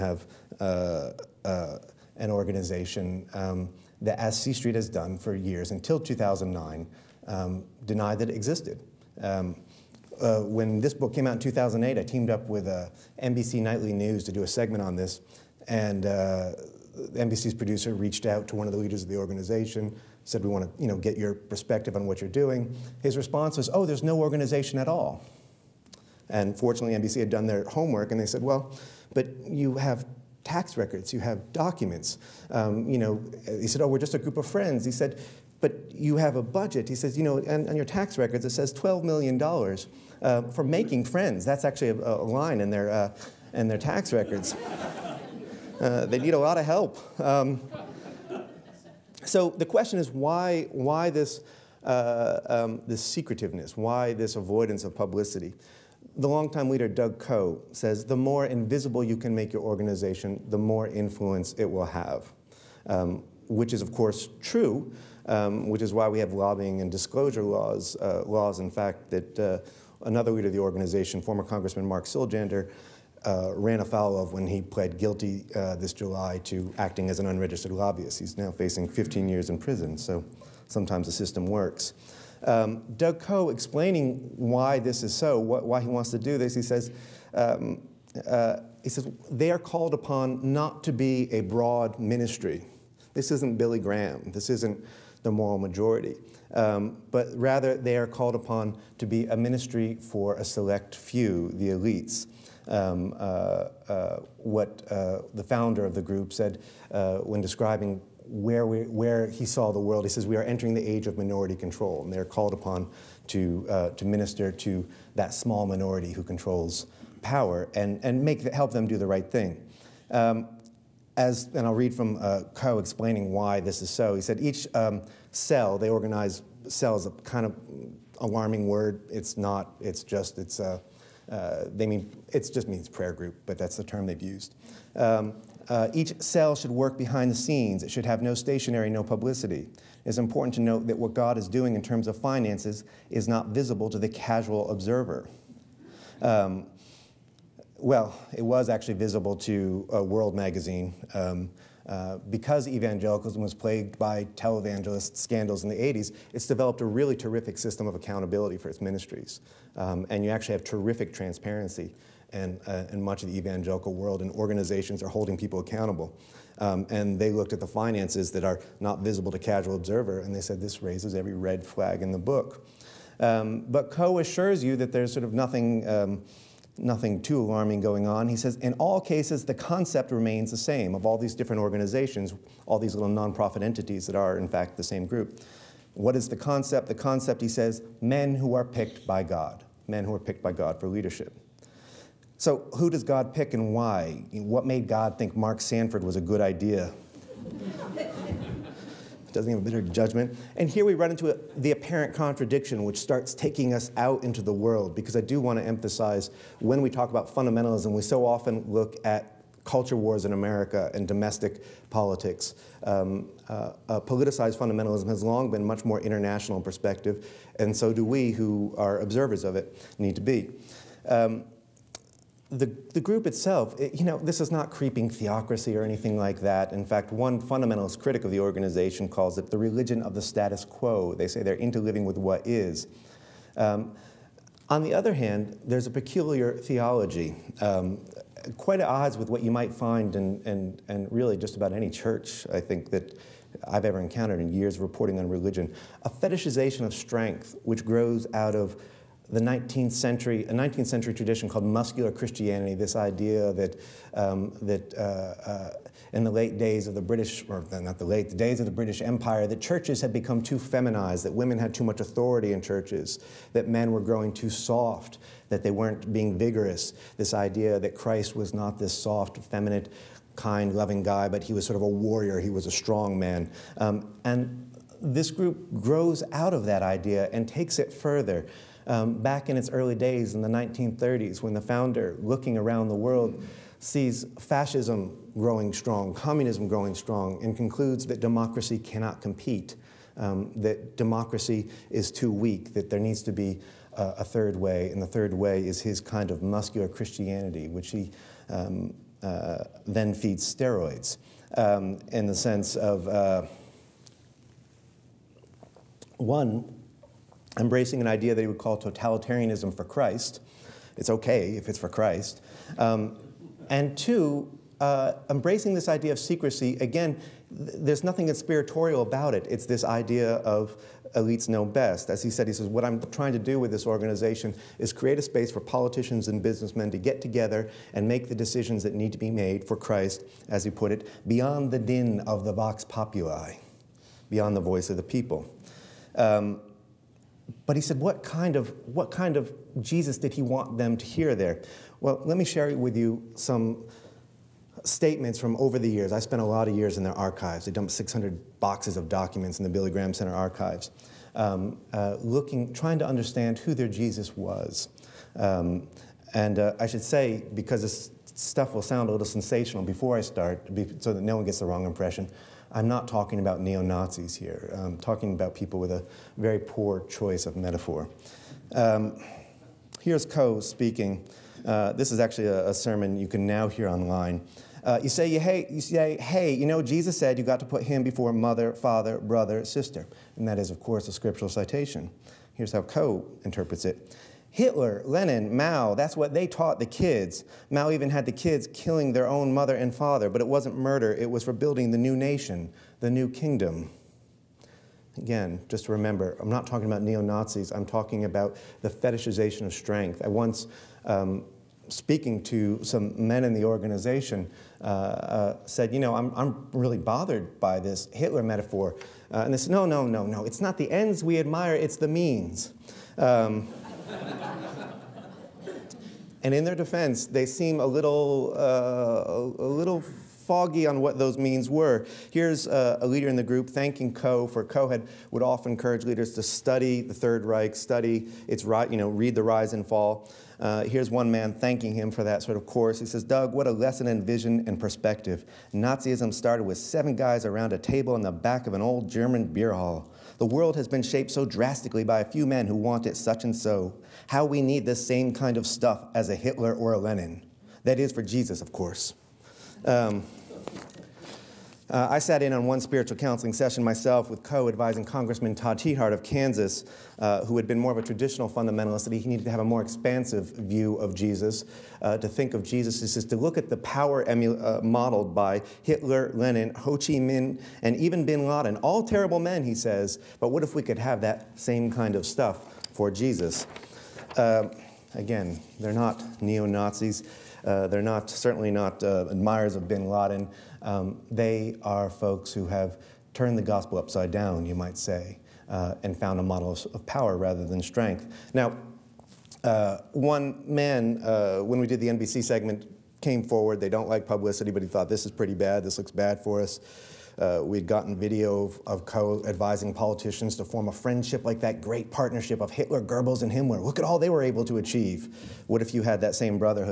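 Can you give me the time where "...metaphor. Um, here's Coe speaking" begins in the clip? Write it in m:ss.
6:07.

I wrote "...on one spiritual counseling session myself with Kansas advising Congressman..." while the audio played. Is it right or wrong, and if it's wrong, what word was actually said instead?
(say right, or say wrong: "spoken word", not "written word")
wrong: "Coe", not "Kansas".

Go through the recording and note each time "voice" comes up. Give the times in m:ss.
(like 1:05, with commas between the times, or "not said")
5:34.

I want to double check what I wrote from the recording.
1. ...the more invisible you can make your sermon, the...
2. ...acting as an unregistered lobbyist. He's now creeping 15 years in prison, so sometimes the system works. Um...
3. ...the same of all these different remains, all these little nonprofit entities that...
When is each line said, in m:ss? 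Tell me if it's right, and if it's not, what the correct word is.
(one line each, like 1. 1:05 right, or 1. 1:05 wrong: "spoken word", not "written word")
1. 0:58 wrong: "organization", not "sermon"
2. 1:16 wrong: "facing", not "creeping"
3. 3:00 wrong: "organizations", not "remains".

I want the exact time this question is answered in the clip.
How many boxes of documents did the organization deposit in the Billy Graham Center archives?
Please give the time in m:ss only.
5:47.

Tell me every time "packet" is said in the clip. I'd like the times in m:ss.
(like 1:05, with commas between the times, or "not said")
not said.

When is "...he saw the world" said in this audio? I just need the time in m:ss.
1:49.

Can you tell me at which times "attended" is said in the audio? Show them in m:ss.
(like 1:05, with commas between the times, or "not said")
not said.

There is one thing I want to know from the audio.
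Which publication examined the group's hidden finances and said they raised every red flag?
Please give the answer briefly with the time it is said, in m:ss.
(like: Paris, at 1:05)
World Magazine, at 2:30.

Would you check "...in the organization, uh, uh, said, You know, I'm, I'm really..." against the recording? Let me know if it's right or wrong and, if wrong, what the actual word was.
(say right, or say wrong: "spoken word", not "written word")
right.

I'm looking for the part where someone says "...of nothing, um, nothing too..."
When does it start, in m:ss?
2:55.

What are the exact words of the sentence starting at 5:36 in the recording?
Um, but he said, what kind, of, what kind of Jesus did he want them to hear there?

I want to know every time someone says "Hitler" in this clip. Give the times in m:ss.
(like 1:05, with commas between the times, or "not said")
6:24, 6:48, 7:26, 7:45, 8:22.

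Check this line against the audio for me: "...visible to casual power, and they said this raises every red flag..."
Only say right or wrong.
wrong.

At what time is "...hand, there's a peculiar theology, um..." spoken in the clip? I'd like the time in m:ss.
3:55.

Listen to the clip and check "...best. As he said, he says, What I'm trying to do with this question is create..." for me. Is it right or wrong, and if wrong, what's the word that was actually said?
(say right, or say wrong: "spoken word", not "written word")
wrong: "organization", not "question".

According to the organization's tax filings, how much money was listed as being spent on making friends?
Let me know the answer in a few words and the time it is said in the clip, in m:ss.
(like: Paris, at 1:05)
$12 million, at 0:38.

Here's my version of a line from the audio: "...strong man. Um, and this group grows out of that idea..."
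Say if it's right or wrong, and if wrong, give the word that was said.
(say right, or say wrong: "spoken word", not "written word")
right.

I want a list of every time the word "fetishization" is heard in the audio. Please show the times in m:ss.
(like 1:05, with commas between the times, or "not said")
4:06, 6:38.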